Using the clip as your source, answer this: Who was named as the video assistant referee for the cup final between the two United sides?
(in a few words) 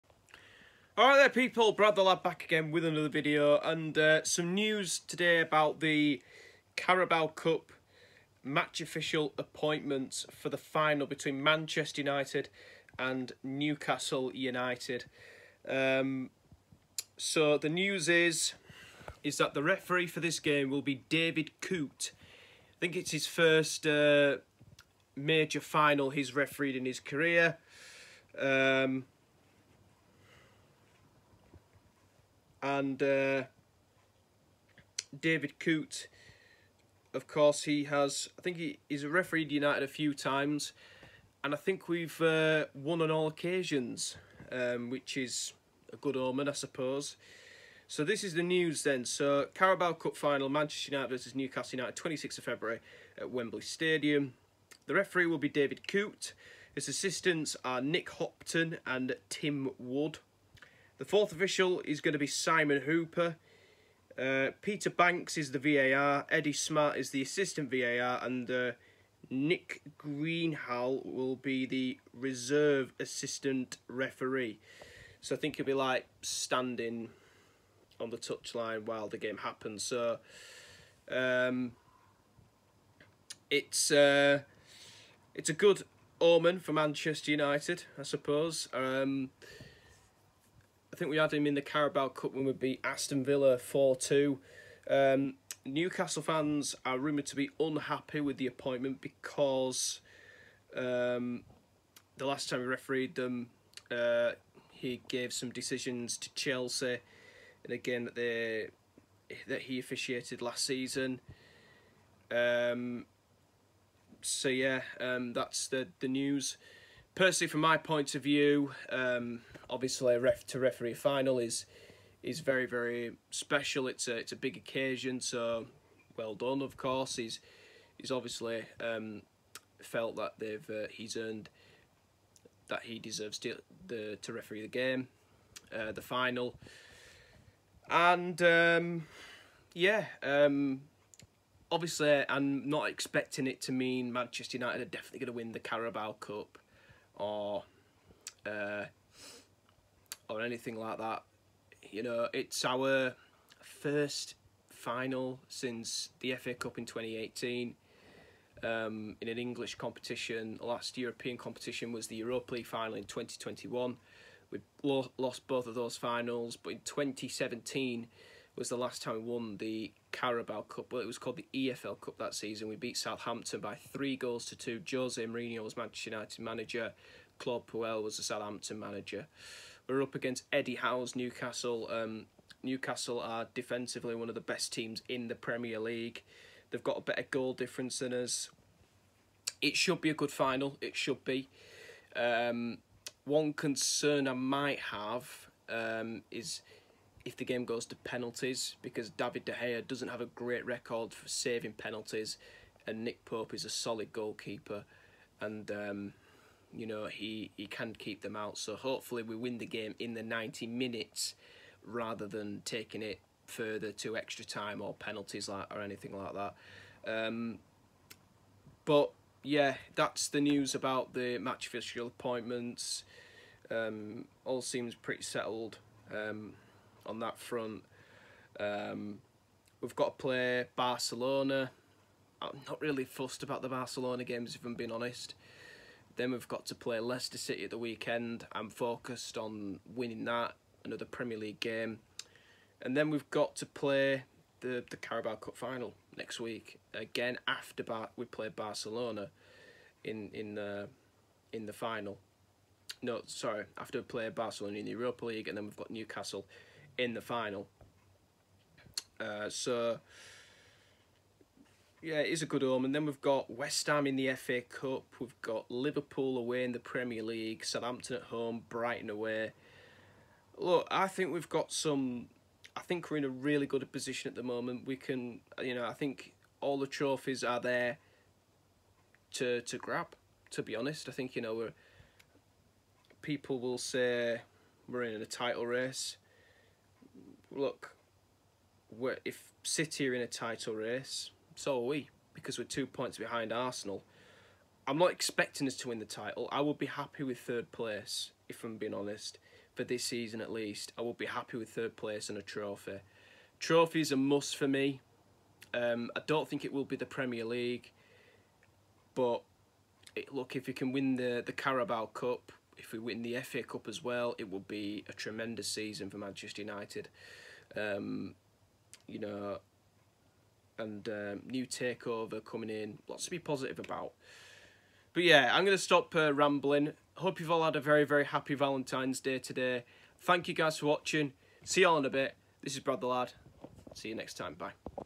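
Peter Bankes.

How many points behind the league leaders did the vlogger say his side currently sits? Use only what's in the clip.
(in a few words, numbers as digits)
2.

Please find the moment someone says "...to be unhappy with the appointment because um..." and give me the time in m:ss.
1:37.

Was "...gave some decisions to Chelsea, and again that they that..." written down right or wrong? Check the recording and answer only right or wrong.
right.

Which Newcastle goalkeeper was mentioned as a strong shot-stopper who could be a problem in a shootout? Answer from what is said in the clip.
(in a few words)
Nick Pope.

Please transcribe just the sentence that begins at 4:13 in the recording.
No, sorry, after we play Barcelona in the Europa League, and then we've got Newcastle in the final.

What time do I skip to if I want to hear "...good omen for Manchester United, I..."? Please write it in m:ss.
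1:25.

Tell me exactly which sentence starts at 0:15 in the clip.
Um, so the news is is that the referee for this game will be David Coote.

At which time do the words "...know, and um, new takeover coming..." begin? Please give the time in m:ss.
5:19.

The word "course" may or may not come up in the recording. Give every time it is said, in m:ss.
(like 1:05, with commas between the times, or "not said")
0:37, 2:06.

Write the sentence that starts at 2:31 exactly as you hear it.
You know, it's our first final since the FA Cup in 2018 um, in an English competition.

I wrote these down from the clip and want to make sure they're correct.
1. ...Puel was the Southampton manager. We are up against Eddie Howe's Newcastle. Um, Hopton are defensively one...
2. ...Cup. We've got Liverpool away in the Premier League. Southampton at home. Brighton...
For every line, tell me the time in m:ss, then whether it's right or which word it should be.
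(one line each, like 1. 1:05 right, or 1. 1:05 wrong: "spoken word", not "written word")
1. 2:57 wrong: "Newcastle", not "Hopton"
2. 4:24 right.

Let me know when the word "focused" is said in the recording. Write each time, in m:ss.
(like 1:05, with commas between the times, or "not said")
3:58.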